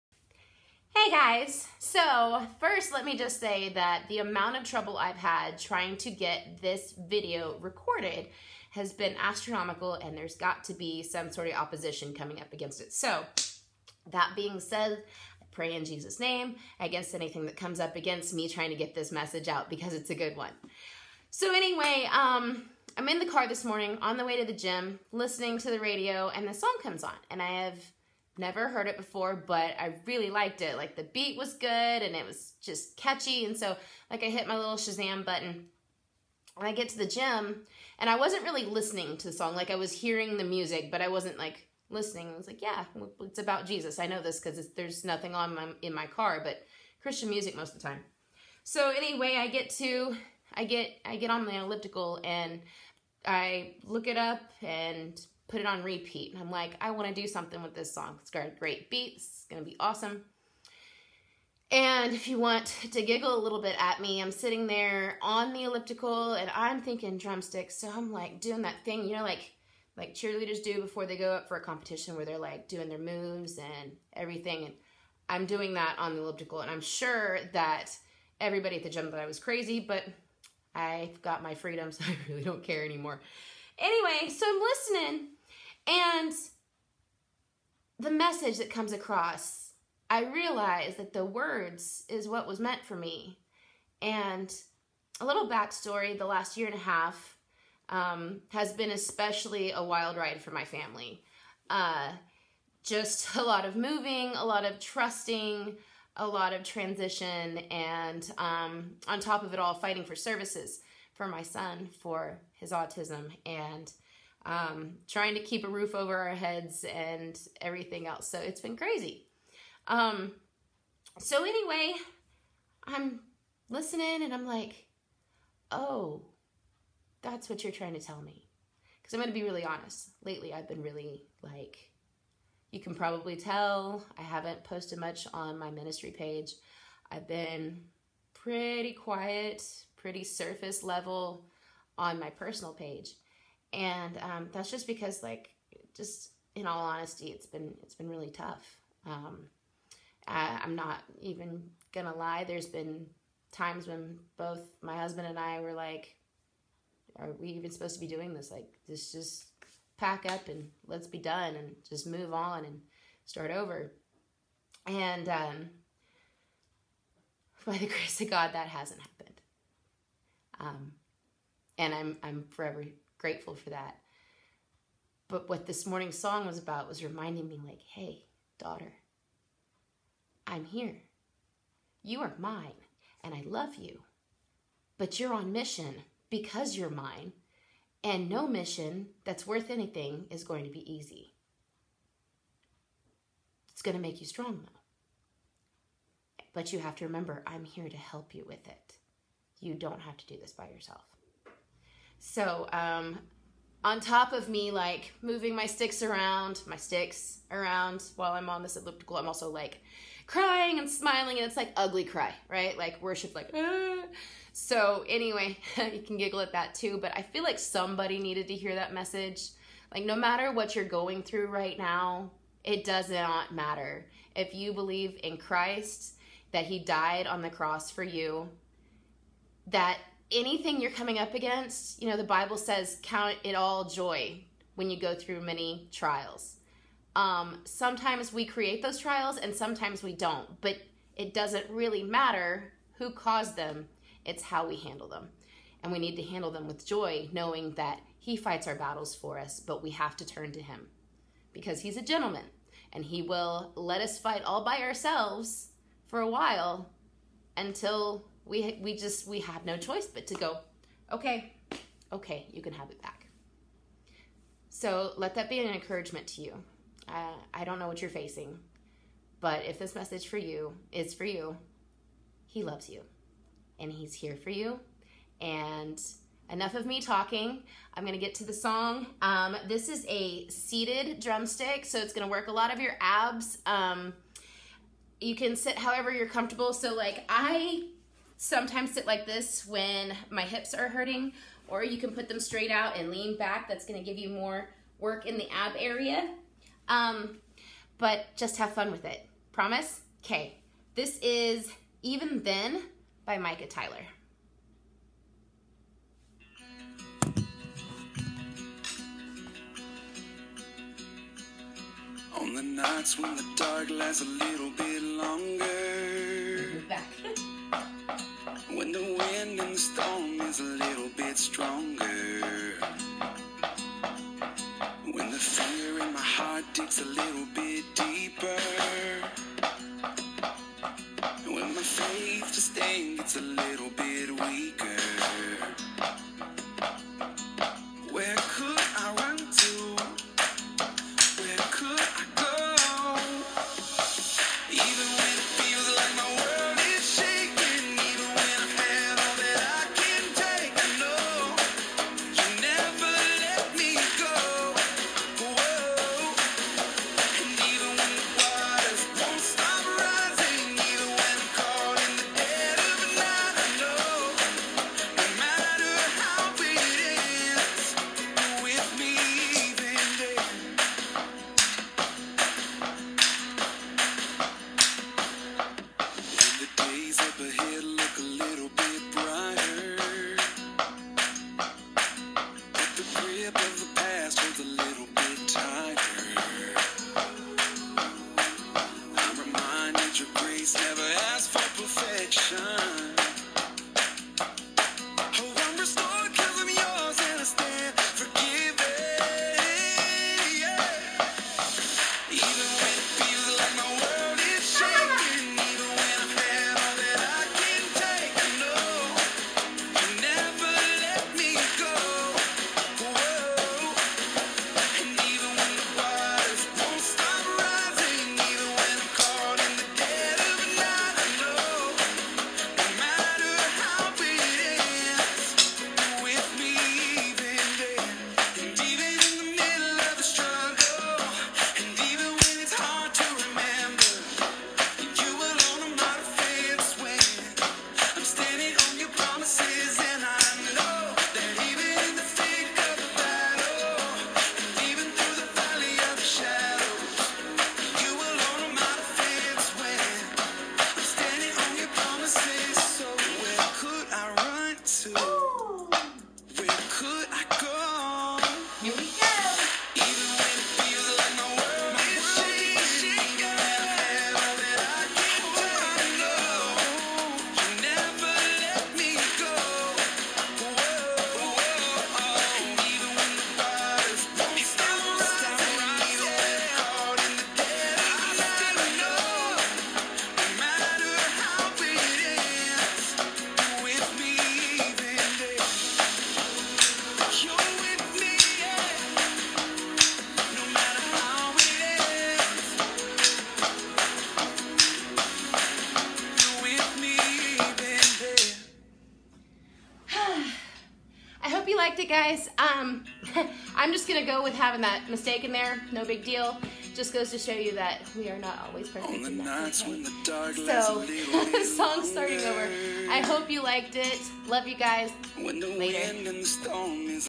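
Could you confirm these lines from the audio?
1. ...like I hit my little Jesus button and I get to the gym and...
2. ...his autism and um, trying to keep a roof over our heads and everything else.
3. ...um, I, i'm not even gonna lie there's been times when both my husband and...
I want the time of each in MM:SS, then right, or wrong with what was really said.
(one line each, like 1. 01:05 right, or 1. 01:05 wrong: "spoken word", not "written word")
1. 00:34 wrong: "Shazam", not "Jesus"
2. 01:52 right
3. 02:29 right.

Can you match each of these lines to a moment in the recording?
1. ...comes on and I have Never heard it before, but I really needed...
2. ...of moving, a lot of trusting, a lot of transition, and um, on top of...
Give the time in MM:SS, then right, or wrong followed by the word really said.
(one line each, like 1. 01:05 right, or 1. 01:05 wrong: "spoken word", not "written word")
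1. 00:26 wrong: "liked", not "needed"
2. 01:43 right.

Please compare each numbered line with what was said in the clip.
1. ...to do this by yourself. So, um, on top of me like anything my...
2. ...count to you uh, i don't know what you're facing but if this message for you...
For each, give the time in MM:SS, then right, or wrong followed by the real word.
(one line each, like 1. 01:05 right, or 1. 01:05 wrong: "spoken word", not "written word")
1. 03:20 wrong: "moving", not "anything"
2. 04:25 wrong: "encouragement", not "count".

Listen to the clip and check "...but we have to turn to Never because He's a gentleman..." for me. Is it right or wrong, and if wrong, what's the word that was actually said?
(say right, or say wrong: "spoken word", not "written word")
wrong: "Him", not "Never".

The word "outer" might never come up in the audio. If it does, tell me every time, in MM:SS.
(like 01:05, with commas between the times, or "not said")
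not said.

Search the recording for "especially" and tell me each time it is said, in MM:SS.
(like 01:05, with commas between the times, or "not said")
01:38.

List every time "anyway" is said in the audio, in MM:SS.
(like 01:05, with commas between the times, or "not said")
00:21, 00:48, 01:23, 02:01, 03:35.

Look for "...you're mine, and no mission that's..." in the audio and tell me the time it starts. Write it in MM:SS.
03:06.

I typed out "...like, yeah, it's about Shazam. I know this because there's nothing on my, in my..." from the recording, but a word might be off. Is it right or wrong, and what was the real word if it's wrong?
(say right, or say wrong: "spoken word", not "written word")
wrong: "Jesus", not "Shazam".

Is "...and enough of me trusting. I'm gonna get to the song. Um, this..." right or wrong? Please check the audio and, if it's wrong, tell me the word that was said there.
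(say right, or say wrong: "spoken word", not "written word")
wrong: "talking", not "trusting".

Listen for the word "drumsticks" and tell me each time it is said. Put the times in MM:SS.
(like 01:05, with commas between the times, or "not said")
01:07, 04:41.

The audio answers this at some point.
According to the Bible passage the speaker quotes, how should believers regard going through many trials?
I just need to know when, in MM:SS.
03:53.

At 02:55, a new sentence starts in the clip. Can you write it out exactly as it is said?
But what this morning's song was about was reminding me, like, hey, daughter, I'm here.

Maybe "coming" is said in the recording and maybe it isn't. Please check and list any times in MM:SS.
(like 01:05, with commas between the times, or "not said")
00:12, 03:50.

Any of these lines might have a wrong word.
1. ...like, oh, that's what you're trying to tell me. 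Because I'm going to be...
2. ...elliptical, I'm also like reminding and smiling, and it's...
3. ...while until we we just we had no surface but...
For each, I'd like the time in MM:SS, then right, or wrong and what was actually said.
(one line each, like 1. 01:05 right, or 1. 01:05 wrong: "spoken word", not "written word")
1. 02:04 right
2. 03:28 wrong: "crying", not "reminding"
3. 04:16 wrong: "choice", not "surface".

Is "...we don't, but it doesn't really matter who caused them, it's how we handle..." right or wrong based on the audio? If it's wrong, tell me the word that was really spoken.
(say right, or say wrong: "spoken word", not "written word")
right.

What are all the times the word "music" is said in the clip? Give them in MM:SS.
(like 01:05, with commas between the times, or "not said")
00:40, 00:47.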